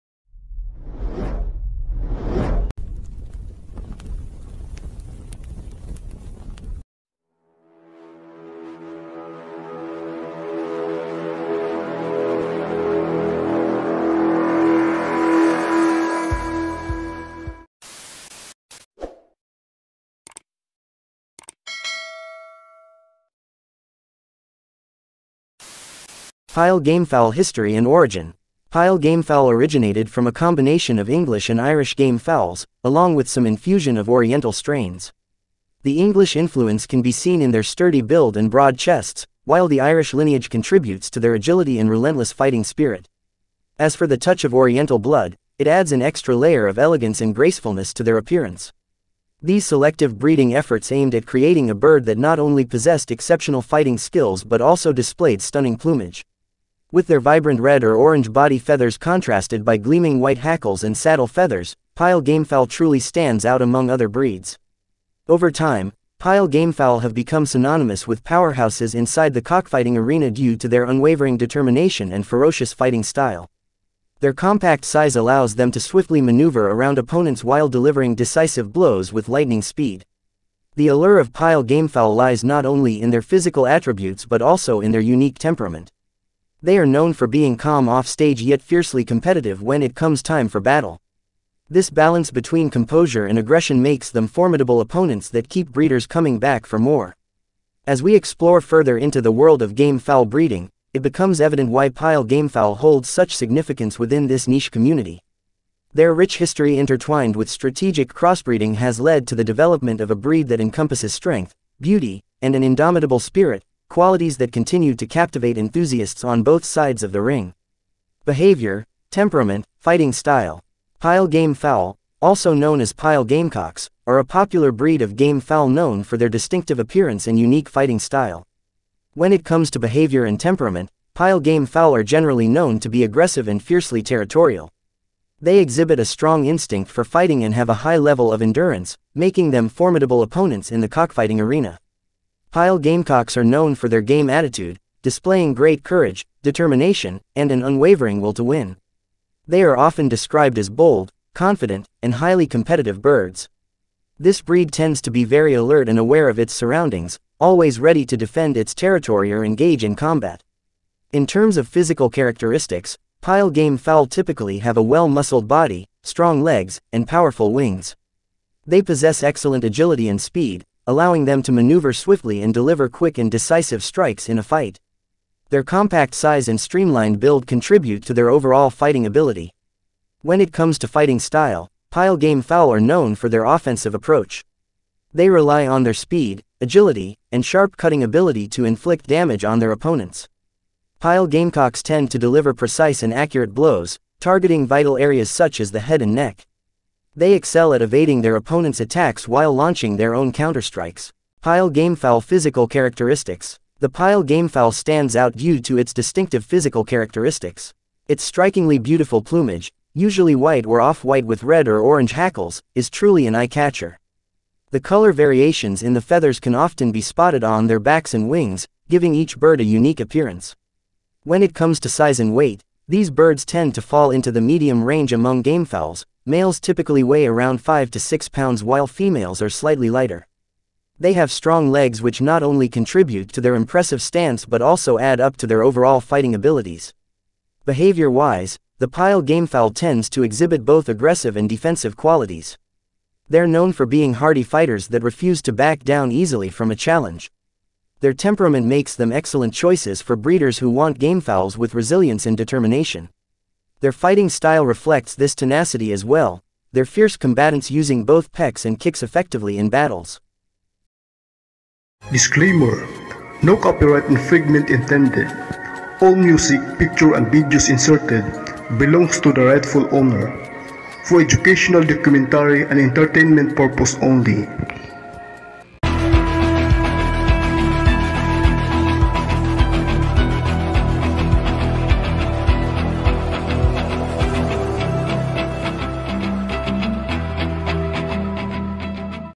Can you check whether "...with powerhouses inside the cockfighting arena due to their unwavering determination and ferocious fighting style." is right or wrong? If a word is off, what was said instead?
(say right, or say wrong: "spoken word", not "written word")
right.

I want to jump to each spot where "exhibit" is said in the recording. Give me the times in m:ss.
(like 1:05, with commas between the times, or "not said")
2:15, 4:00.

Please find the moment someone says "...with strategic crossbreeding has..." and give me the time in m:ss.
1:47.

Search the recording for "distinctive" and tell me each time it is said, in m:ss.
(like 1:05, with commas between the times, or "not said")
2:06, 3:25.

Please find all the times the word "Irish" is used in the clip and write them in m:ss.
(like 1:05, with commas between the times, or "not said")
0:31, 0:39.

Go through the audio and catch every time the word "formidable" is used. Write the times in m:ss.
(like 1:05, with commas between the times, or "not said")
1:34, 2:19.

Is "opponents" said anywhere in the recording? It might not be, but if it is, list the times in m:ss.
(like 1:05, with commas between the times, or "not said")
1:16, 1:34, 2:20, 3:09, 3:18.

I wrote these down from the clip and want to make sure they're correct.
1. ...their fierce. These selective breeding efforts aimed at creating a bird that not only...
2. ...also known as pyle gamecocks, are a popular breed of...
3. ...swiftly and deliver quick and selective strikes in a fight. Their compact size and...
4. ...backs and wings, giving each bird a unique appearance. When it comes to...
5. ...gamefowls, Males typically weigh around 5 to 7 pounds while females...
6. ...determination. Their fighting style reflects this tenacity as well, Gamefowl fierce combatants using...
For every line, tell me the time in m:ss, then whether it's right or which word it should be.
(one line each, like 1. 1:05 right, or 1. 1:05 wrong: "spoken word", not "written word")
1. 0:48 wrong: "appearance", not "fierce"
2. 2:02 right
3. 2:51 wrong: "decisive", not "selective"
4. 3:37 right
5. 3:45 wrong: "6", not "7"
6. 4:12 wrong: "Their", not "Gamefowl".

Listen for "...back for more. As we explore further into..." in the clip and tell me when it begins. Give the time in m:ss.
1:36.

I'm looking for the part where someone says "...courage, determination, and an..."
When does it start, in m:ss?
2:25.